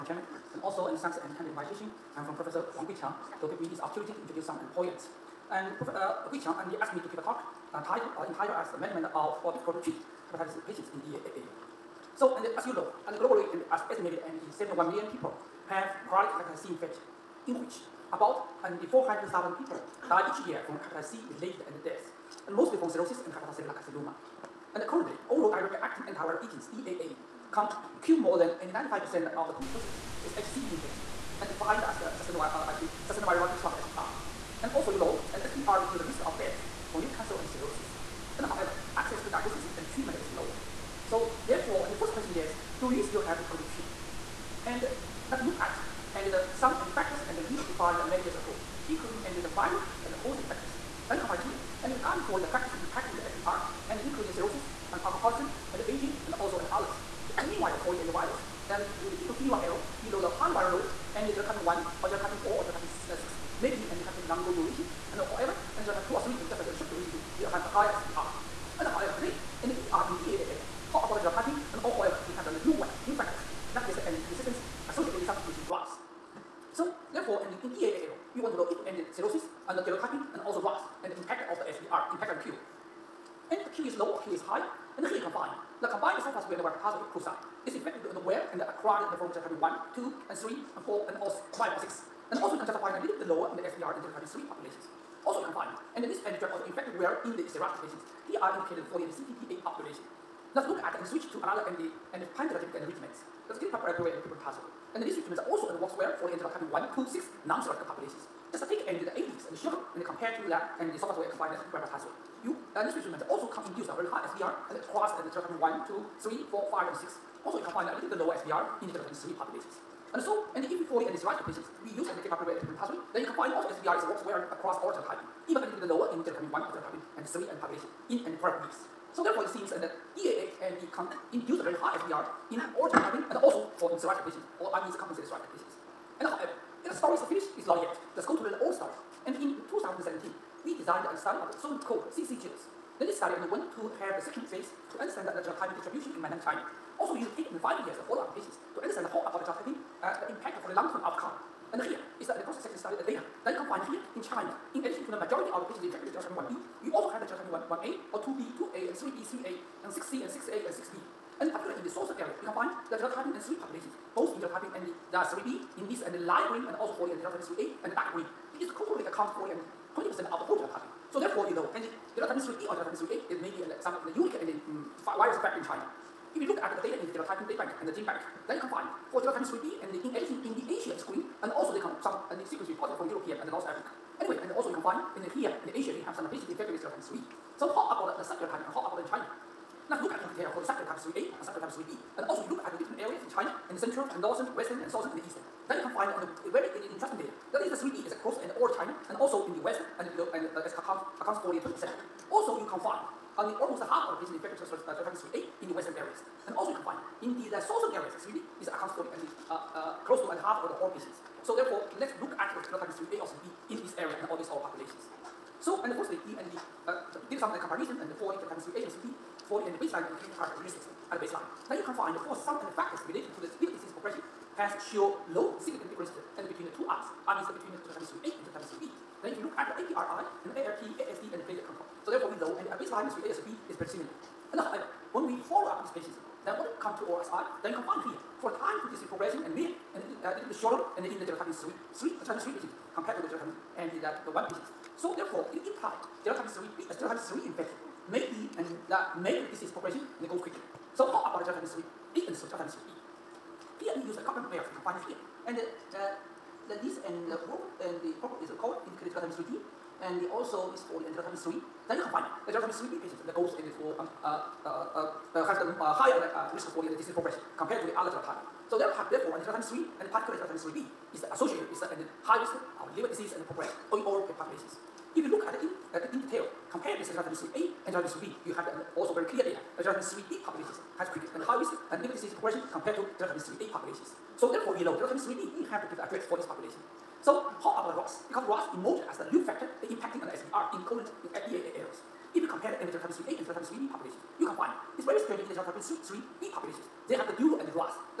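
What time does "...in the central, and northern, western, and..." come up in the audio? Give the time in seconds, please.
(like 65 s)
193 s.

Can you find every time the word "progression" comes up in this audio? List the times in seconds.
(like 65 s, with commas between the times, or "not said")
223 s, 239 s, 249 s, 267 s, 273 s, 282 s.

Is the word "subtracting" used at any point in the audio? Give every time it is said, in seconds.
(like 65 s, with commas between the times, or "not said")
115 s.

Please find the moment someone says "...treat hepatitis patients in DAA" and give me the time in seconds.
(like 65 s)
9 s.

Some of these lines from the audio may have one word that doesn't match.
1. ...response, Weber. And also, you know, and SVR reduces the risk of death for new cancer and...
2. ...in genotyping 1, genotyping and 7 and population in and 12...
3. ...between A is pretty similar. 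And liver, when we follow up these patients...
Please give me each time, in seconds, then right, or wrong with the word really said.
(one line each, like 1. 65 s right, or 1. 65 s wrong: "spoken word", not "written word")
1. 33 s wrong: "SVR", not "Weber"
2. 126 s wrong: "3", not "7"
3. 233 s wrong: "however", not "liver".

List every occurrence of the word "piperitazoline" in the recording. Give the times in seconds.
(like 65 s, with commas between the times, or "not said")
122 s.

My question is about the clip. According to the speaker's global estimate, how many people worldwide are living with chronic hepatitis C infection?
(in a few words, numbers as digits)
71 million.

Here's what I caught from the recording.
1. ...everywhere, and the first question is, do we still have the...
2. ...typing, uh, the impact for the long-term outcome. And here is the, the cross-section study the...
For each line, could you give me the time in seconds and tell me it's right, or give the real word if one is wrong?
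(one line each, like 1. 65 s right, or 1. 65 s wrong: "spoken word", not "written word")
1. 41 s wrong: "therefore", not "everywhere"
2. 149 s right.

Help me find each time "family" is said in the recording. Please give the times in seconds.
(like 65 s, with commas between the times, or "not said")
not said.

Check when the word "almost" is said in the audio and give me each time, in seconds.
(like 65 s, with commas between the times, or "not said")
203 s.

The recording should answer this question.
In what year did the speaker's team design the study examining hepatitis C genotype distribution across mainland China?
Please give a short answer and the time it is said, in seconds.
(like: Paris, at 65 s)
2017, at 139 s.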